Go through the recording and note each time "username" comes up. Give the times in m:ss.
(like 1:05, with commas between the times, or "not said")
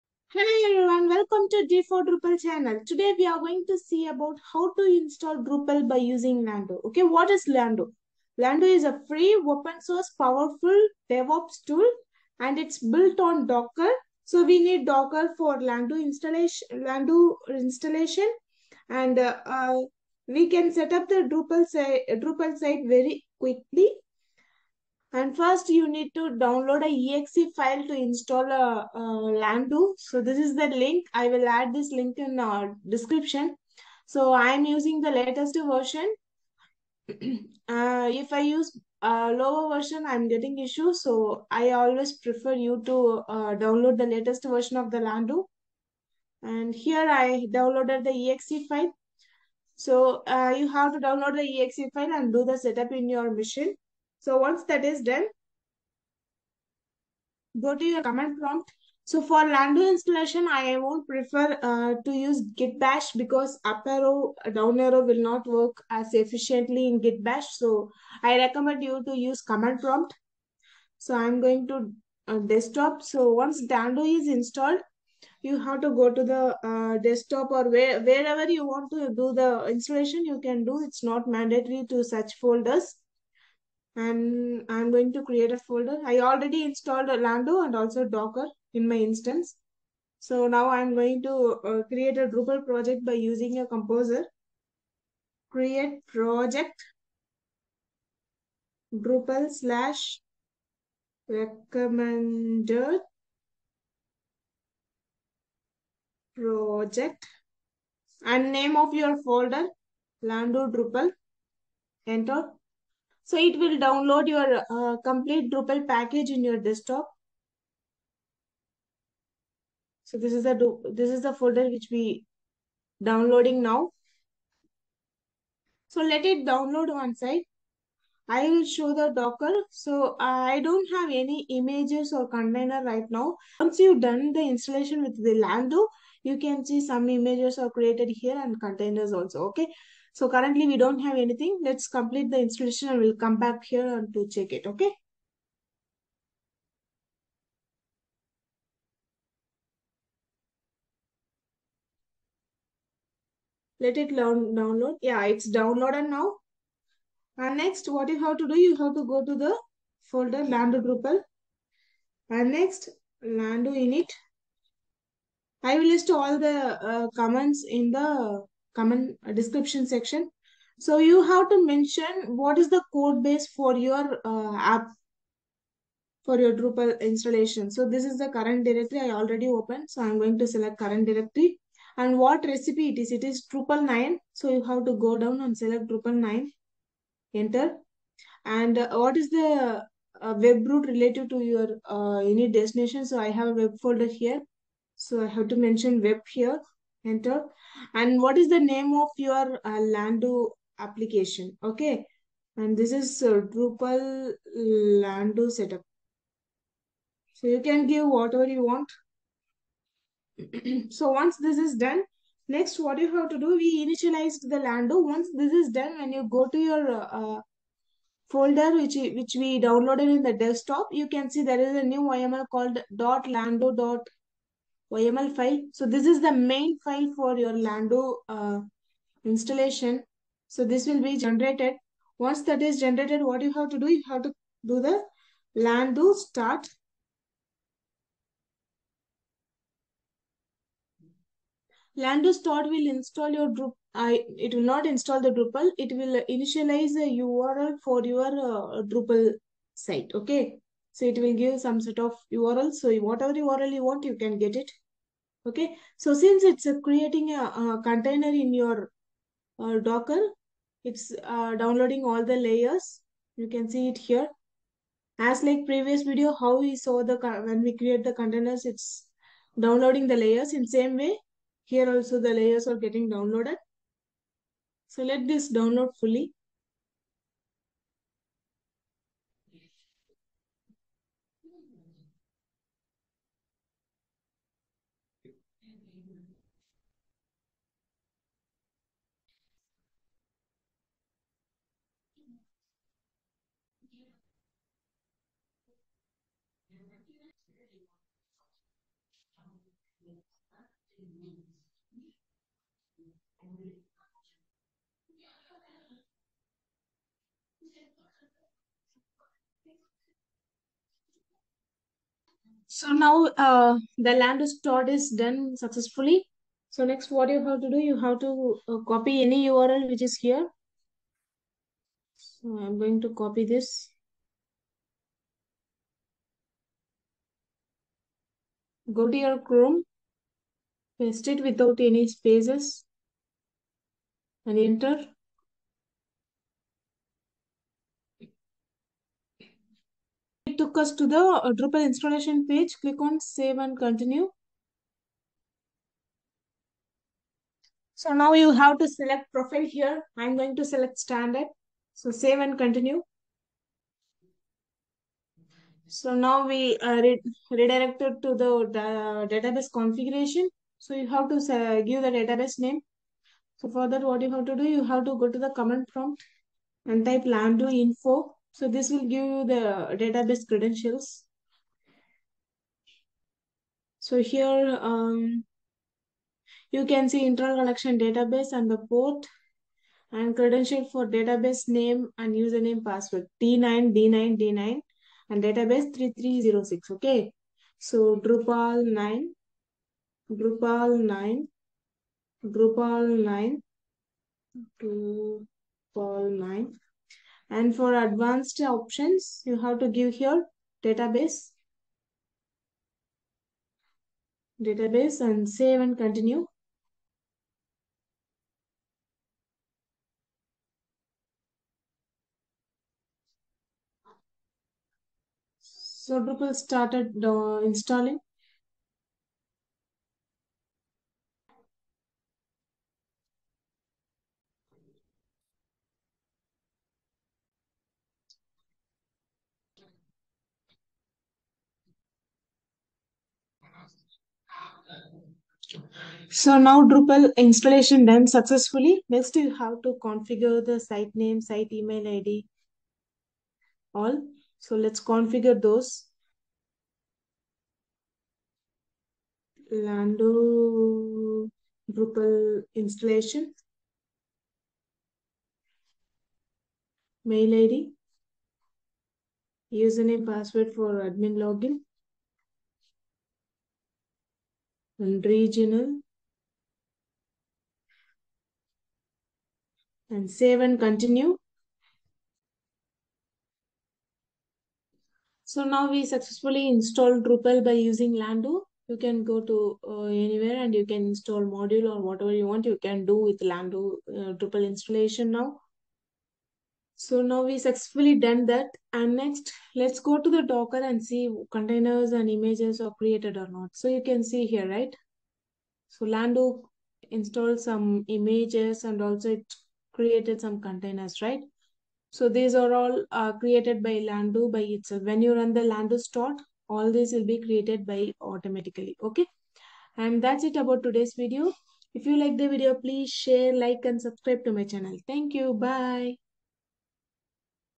6:22, 7:39.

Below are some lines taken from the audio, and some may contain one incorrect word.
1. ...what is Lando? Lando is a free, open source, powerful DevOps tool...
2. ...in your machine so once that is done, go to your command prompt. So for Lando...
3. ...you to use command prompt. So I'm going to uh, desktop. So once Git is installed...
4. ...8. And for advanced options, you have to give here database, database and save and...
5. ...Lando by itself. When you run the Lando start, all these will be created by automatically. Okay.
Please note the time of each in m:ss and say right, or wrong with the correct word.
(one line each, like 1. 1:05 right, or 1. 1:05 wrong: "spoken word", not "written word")
1. 0:07 right
2. 0:52 right
3. 1:08 wrong: "Lando", not "Git"
4. 6:36 wrong: "9", not "8"
5. 8:23 right.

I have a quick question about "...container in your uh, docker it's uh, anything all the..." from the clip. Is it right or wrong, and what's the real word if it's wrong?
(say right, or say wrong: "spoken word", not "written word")
wrong: "downloading", not "anything".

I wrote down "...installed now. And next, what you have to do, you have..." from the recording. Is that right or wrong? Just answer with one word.
wrong.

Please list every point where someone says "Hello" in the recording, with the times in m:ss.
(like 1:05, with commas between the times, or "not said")
0:00.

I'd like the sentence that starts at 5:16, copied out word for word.
So next what you have to do, you have to uh, copy any URL which is here.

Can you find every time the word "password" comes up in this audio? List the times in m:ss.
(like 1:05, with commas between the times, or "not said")
6:22, 7:40.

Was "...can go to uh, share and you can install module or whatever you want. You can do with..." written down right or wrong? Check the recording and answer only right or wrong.
wrong.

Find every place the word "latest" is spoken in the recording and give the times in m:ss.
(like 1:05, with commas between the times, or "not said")
0:35, 0:44.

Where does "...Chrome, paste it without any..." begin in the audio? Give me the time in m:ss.
5:29.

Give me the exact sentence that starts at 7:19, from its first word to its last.
Next you have to configure the site name, site email ID, all.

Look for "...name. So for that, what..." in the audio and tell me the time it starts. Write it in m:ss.
6:02.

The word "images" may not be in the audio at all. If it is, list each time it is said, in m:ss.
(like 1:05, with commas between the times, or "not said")
2:11, 2:17, 8:12, 8:18.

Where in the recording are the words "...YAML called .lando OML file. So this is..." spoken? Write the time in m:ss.
3:42.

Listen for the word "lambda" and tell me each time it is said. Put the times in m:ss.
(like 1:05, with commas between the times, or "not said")
0:29.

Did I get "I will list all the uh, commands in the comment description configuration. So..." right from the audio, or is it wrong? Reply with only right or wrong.
wrong.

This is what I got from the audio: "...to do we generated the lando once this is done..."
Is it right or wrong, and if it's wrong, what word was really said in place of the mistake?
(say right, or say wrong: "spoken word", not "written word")
wrong: "initialized", not "generated".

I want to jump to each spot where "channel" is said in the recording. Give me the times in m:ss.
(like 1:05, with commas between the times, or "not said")
0:02, 8:34.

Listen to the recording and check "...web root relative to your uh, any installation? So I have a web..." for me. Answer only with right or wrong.
wrong.